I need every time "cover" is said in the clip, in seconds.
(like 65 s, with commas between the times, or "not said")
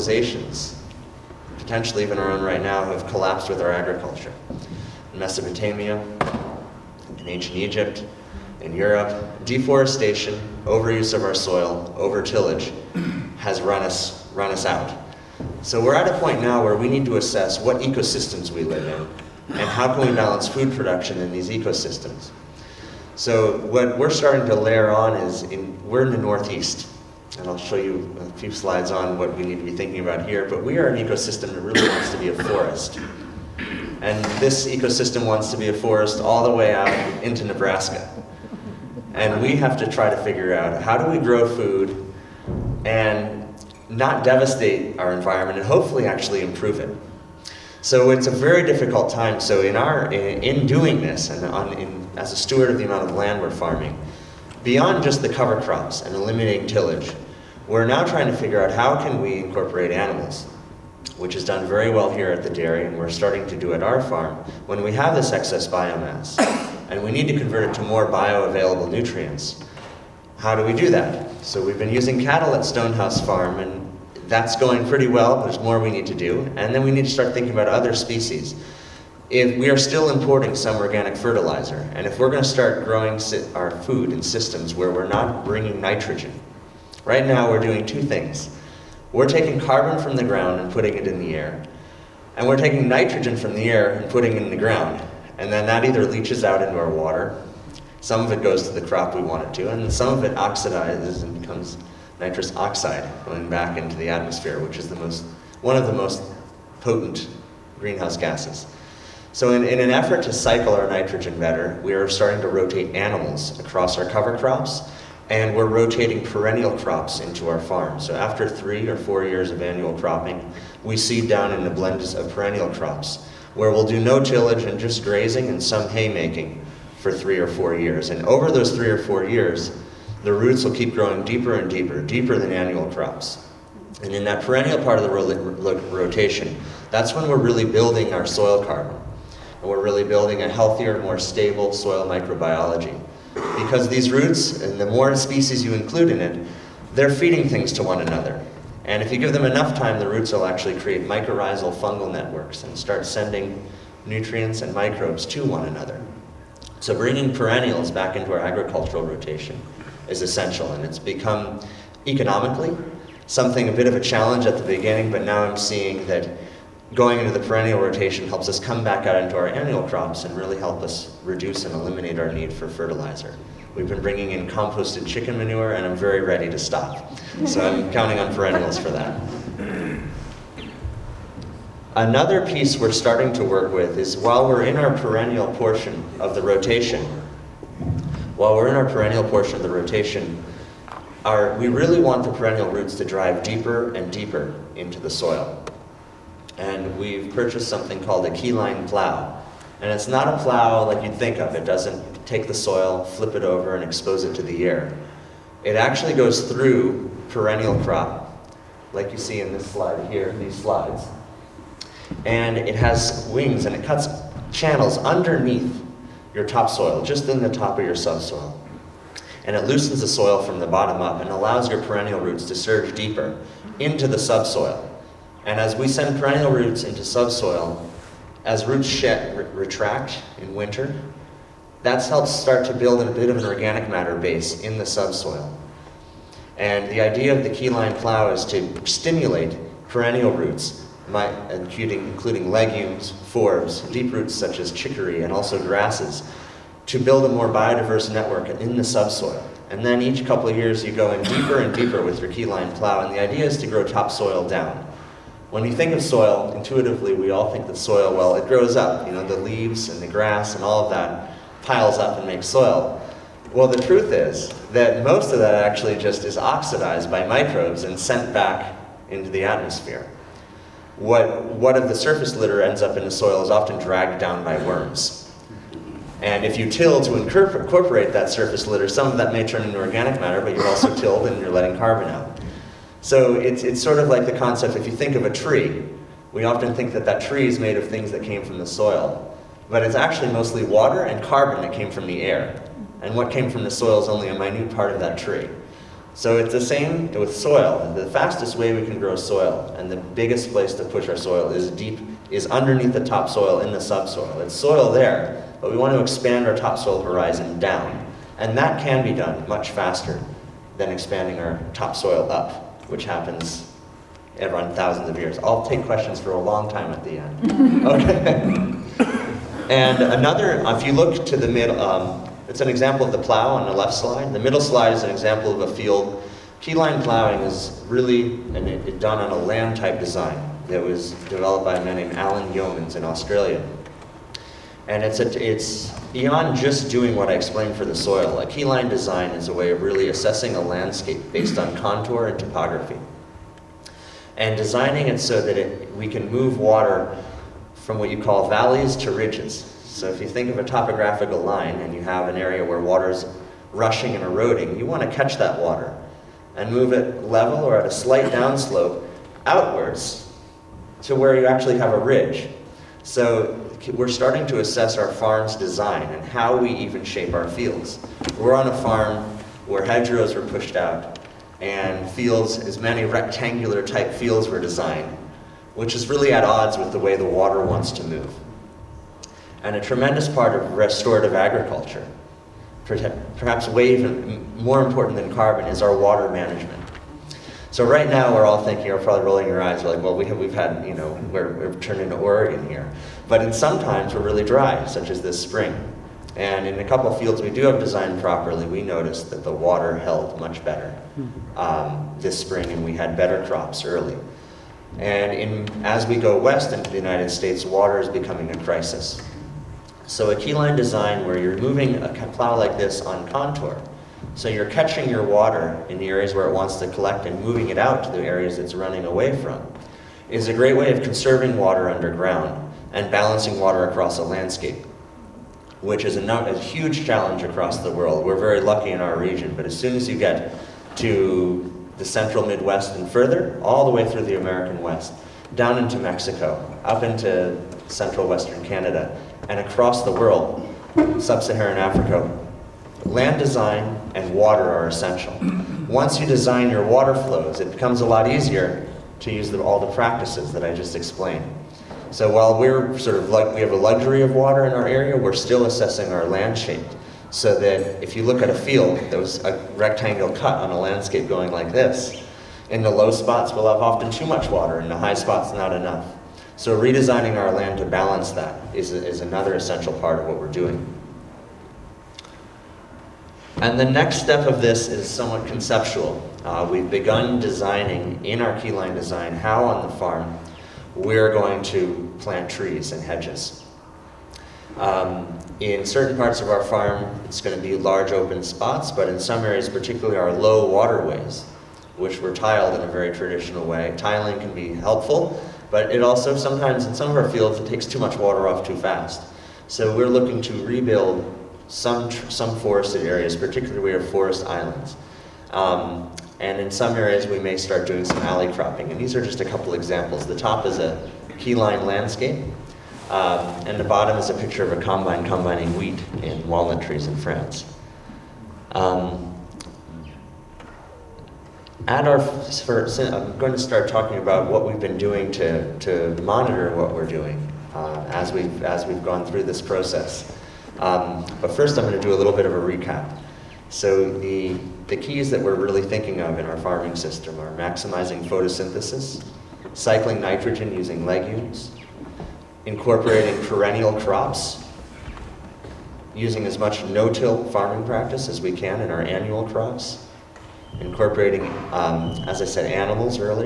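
55 s, 114 s.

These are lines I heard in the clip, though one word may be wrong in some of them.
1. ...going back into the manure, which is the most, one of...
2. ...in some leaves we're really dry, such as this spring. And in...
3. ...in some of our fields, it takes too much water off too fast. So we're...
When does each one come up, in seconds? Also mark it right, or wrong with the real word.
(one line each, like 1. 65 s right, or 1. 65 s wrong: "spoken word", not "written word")
1. 103 s wrong: "atmosphere", not "manure"
2. 393 s wrong: "times", not "leaves"
3. 496 s right.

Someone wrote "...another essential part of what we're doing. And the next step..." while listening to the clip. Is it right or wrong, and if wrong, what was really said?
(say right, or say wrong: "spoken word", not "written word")
right.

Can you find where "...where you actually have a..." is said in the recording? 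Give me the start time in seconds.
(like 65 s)
361 s.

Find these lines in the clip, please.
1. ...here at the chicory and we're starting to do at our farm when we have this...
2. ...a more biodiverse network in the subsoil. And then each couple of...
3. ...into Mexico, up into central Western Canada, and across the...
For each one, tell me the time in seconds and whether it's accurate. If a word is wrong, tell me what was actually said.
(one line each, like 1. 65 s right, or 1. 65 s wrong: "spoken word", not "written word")
1. 62 s wrong: "dairy", not "chicory"
2. 247 s right
3. 435 s right.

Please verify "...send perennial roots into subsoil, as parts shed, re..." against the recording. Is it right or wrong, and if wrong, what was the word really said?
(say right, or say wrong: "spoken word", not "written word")
wrong: "roots", not "parts".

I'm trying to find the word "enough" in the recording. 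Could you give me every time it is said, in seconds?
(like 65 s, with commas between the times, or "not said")
149 s, 465 s.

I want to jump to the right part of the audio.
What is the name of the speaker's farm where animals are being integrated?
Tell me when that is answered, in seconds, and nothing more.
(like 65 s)
72 s.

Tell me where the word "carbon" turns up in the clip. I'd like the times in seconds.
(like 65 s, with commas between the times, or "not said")
89 s, 138 s, 281 s, 291 s, 385 s.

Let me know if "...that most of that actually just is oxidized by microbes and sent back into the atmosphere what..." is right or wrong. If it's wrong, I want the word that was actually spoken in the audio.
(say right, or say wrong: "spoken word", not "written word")
right.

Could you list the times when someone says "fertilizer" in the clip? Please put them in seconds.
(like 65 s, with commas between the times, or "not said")
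81 s, 172 s.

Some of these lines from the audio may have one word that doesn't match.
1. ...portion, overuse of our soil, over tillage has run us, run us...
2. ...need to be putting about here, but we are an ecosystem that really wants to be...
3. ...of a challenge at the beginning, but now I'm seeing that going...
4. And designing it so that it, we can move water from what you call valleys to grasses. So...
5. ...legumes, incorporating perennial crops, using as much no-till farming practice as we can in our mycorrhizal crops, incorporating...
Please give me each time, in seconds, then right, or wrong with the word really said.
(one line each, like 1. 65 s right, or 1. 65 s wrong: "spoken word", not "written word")
1. 9 s wrong: "deforestation", not "portion"
2. 29 s wrong: "thinking", not "putting"
3. 163 s right
4. 344 s wrong: "ridges", not "grasses"
5. 541 s wrong: "annual", not "mycorrhizal".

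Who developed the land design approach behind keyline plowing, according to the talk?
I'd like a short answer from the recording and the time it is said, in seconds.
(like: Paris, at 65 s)
Alan Yeomans, at 332 s.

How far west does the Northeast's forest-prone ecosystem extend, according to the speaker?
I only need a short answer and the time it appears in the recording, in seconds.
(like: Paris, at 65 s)
Nebraska, at 37 s.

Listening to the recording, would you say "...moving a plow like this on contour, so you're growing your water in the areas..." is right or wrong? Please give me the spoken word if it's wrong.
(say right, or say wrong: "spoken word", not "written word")
wrong: "catching", not "growing".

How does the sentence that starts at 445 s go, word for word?
Once you design your water flows, it becomes a lot easier to use the, all the practices that I just explained.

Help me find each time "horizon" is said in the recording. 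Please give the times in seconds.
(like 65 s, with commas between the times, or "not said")
307 s.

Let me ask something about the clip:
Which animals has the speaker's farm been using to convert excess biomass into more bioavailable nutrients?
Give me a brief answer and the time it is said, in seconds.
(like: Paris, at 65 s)
Cattle, at 72 s.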